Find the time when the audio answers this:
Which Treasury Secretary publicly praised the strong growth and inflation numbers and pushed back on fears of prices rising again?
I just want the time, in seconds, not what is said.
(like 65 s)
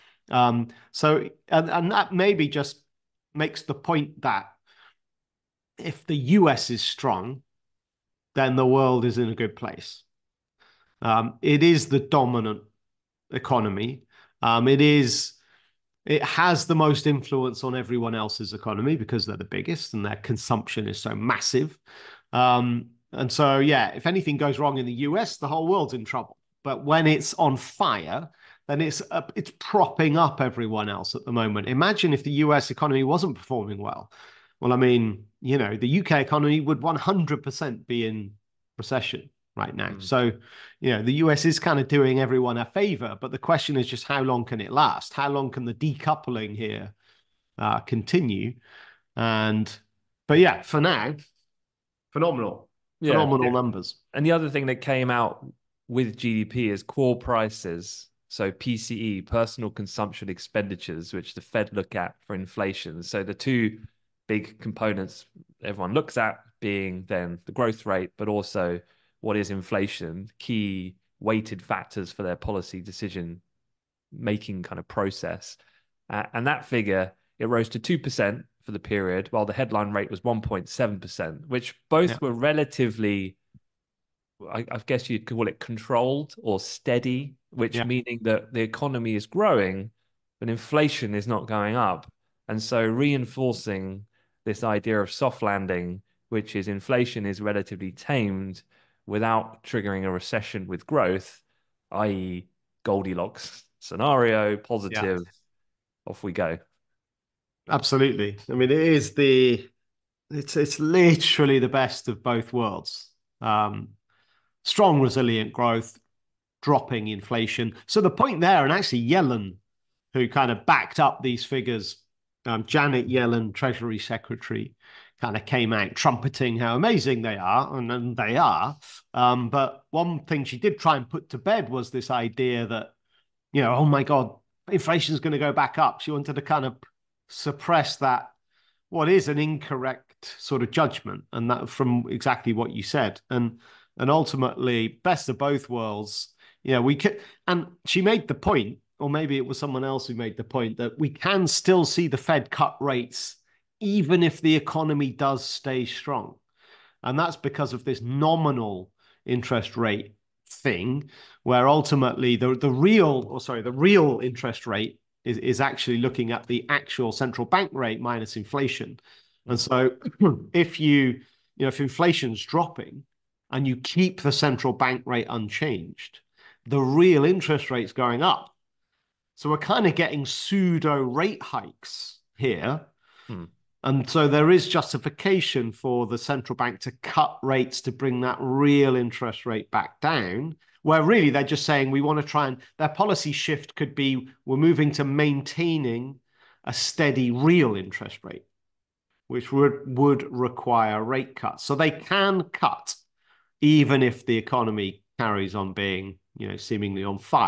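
122 s.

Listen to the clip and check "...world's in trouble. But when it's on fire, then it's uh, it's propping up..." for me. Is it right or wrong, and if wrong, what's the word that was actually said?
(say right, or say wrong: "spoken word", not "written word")
right.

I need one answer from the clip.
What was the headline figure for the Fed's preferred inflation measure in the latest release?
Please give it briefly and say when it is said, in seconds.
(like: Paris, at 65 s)
1.7%, at 80 s.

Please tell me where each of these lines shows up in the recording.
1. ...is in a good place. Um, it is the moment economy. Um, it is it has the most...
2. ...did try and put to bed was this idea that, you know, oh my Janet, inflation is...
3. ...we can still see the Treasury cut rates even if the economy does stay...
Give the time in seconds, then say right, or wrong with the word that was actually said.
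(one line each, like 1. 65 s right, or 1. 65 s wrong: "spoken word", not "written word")
1. 9 s wrong: "dominant", not "moment"
2. 130 s wrong: "God", not "Janet"
3. 150 s wrong: "Fed", not "Treasury".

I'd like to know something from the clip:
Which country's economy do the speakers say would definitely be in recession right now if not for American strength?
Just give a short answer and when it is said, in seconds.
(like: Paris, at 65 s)
UK, at 35 s.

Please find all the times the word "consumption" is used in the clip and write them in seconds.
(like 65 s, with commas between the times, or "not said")
20 s, 59 s.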